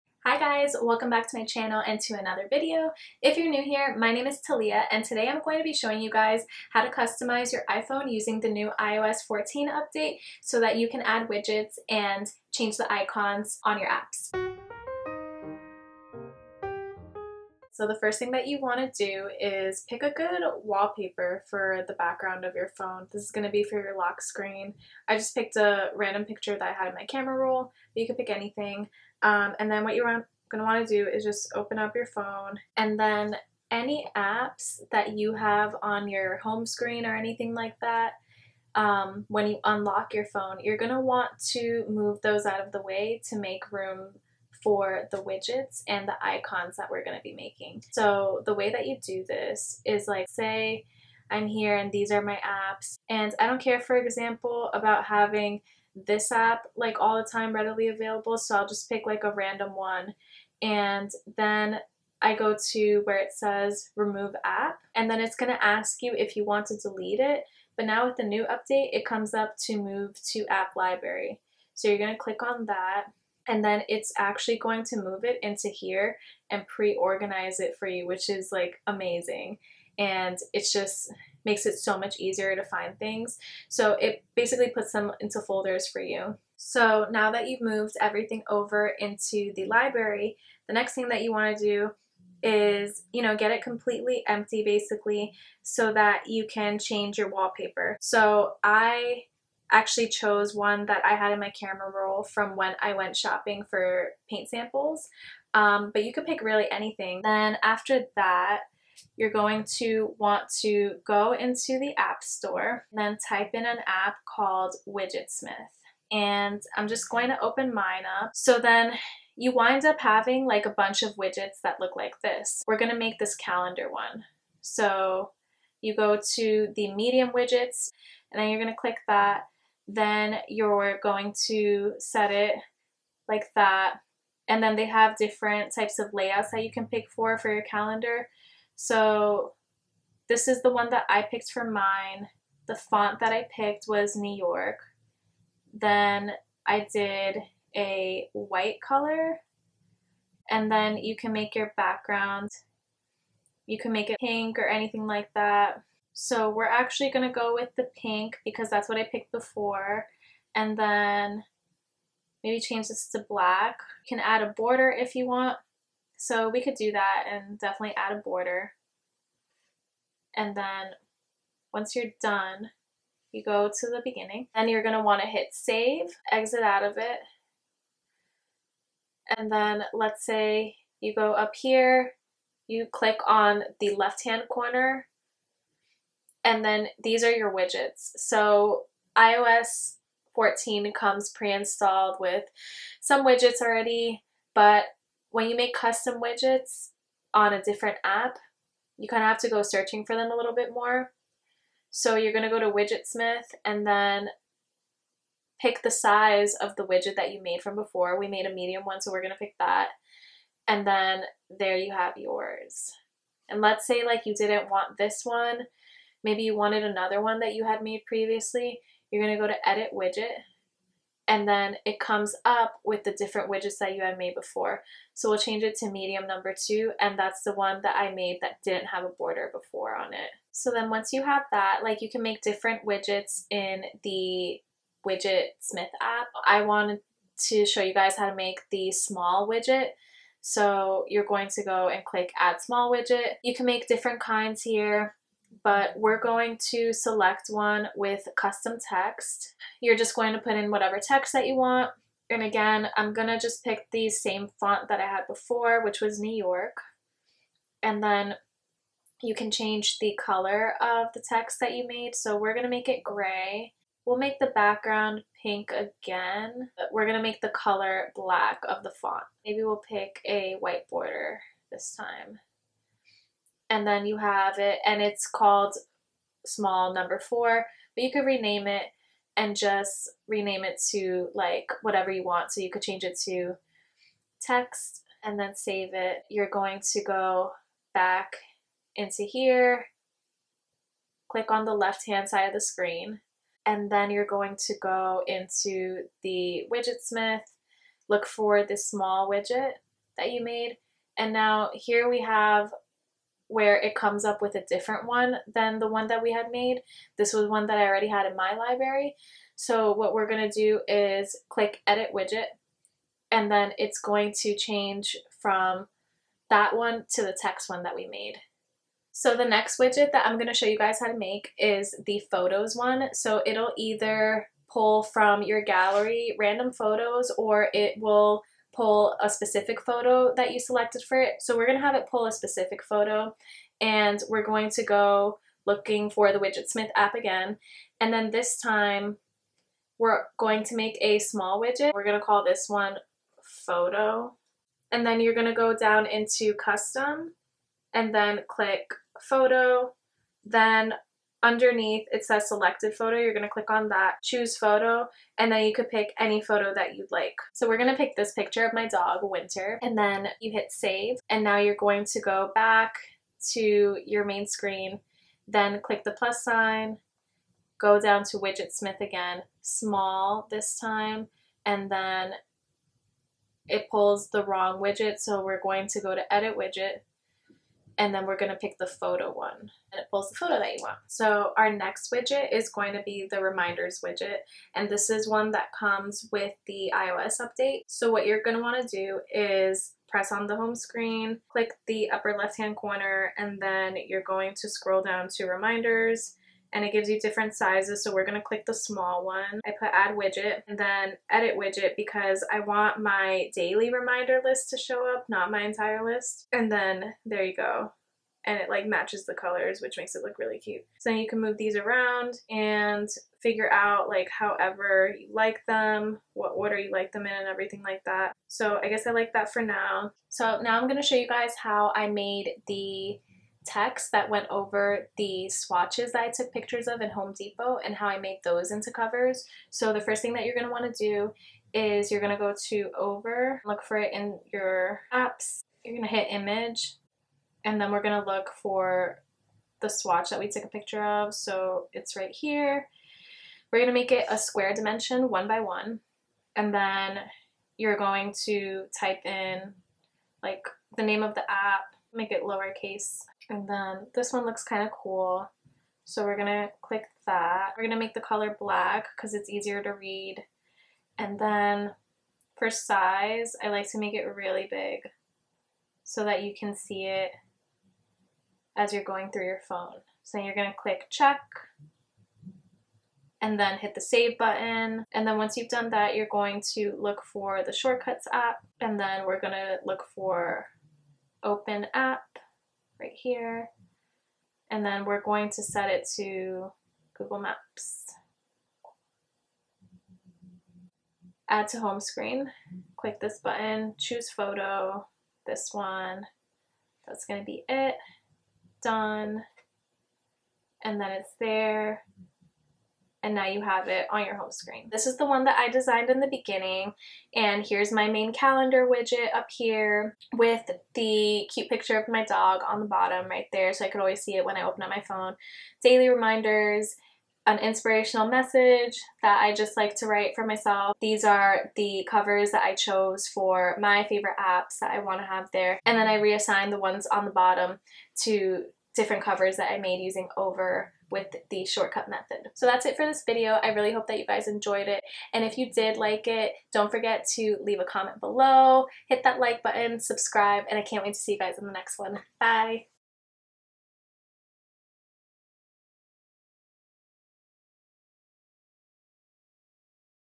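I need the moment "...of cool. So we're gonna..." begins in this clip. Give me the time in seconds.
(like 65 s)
454 s.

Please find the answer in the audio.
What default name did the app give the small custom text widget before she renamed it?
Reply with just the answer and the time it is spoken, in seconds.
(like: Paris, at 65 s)
small number four, at 276 s.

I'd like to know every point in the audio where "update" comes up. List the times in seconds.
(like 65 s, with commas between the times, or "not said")
9 s, 68 s, 387 s.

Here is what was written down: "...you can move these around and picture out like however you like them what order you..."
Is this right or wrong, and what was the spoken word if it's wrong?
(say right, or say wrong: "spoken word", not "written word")
wrong: "figure", not "picture".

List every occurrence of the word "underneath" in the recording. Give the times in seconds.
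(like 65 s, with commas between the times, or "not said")
351 s.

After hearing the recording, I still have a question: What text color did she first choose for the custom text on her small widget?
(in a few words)
gray.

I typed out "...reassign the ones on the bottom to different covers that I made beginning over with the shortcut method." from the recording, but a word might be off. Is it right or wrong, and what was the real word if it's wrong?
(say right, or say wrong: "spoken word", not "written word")
wrong: "using", not "beginning".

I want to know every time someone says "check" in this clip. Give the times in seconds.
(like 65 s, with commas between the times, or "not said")
471 s.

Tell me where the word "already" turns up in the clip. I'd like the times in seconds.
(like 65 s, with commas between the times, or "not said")
193 s, 307 s.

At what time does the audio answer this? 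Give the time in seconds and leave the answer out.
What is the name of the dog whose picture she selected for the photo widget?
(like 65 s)
359 s.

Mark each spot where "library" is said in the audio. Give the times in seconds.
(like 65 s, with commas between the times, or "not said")
70 s, 89 s, 308 s.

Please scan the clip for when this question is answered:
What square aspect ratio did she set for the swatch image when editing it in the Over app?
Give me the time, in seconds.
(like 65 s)
445 s.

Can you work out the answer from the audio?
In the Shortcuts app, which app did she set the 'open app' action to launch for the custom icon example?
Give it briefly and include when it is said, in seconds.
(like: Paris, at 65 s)
Google Maps, at 487 s.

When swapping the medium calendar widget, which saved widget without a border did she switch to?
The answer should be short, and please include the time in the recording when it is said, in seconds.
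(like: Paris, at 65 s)
medium number two, at 225 s.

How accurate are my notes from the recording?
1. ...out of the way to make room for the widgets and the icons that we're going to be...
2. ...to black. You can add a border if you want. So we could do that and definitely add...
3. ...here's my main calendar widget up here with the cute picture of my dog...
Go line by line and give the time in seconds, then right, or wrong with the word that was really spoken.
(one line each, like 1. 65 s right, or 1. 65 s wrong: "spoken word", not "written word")
1. 42 s right
2. 163 s right
3. 507 s right.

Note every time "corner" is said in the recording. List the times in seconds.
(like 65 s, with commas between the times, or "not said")
184 s, 392 s.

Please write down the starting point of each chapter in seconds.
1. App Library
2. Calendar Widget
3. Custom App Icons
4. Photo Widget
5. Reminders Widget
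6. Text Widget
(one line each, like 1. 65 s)
1. 59 s
2. 123 s
3. 421 s
4. 319 s
5. 381 s
6. 238 s.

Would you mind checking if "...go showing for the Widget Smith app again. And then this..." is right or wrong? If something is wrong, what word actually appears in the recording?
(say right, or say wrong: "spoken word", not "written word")
wrong: "looking", not "showing".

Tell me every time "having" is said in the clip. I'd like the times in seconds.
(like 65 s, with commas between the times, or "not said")
55 s, 120 s.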